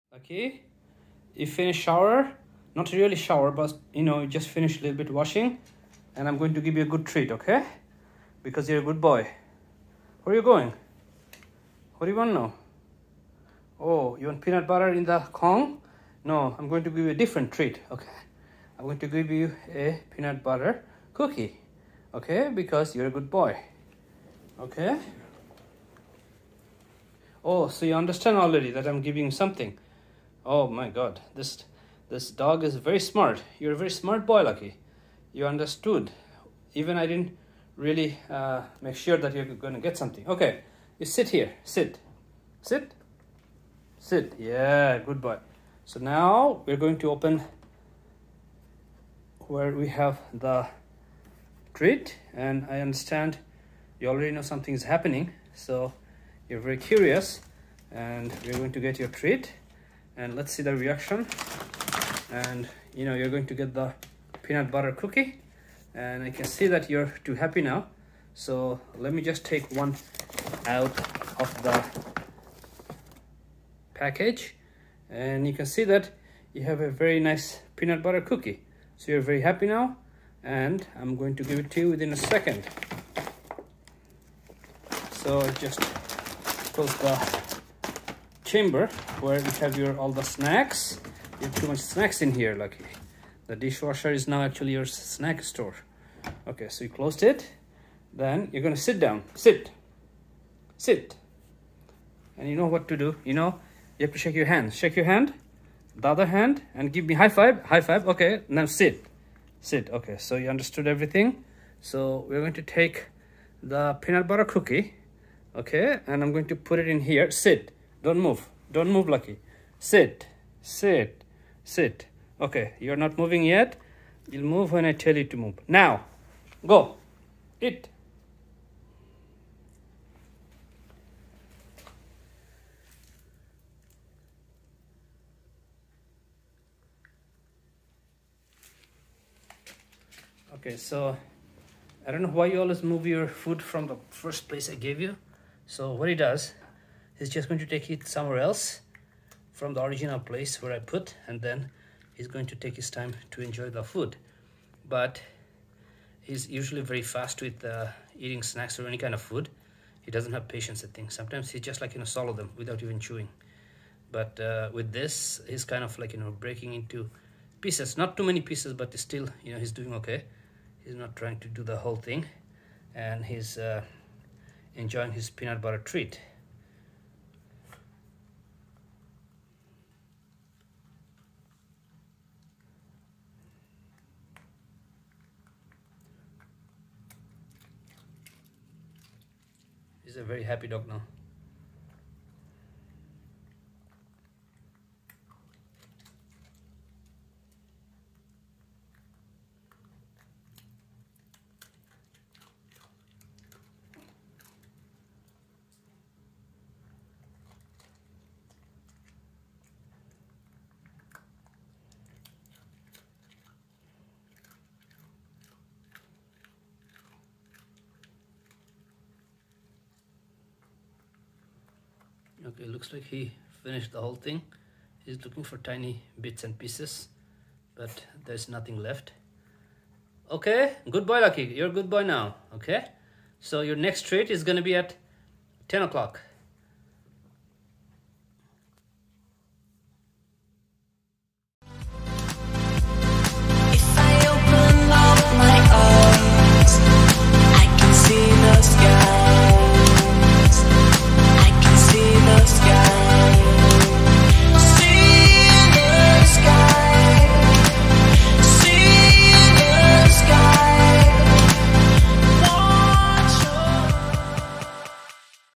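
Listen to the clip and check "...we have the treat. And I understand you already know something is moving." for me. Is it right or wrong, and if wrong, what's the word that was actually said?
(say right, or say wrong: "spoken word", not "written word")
wrong: "happening", not "moving".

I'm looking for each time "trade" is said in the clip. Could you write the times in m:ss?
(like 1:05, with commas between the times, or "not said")
3:54.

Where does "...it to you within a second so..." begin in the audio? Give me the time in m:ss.
1:21.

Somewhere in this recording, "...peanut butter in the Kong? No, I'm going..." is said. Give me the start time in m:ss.
0:14.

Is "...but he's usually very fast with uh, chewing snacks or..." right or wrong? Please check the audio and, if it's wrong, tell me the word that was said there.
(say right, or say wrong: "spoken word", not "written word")
wrong: "eating", not "chewing".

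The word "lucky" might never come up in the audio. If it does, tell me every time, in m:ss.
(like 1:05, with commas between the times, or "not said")
0:34, 1:32, 1:59, 3:51.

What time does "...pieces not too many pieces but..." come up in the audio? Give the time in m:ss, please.
2:47.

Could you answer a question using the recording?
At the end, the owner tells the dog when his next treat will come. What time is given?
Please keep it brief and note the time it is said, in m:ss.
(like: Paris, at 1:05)
10 o'clock, at 3:55.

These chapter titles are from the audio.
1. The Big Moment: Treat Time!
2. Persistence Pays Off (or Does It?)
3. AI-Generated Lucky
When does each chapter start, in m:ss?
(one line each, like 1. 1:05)
1. 1:15
2. 0:45
3. 4:00.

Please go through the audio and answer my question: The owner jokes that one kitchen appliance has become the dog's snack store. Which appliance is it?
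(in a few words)
Dishwasher.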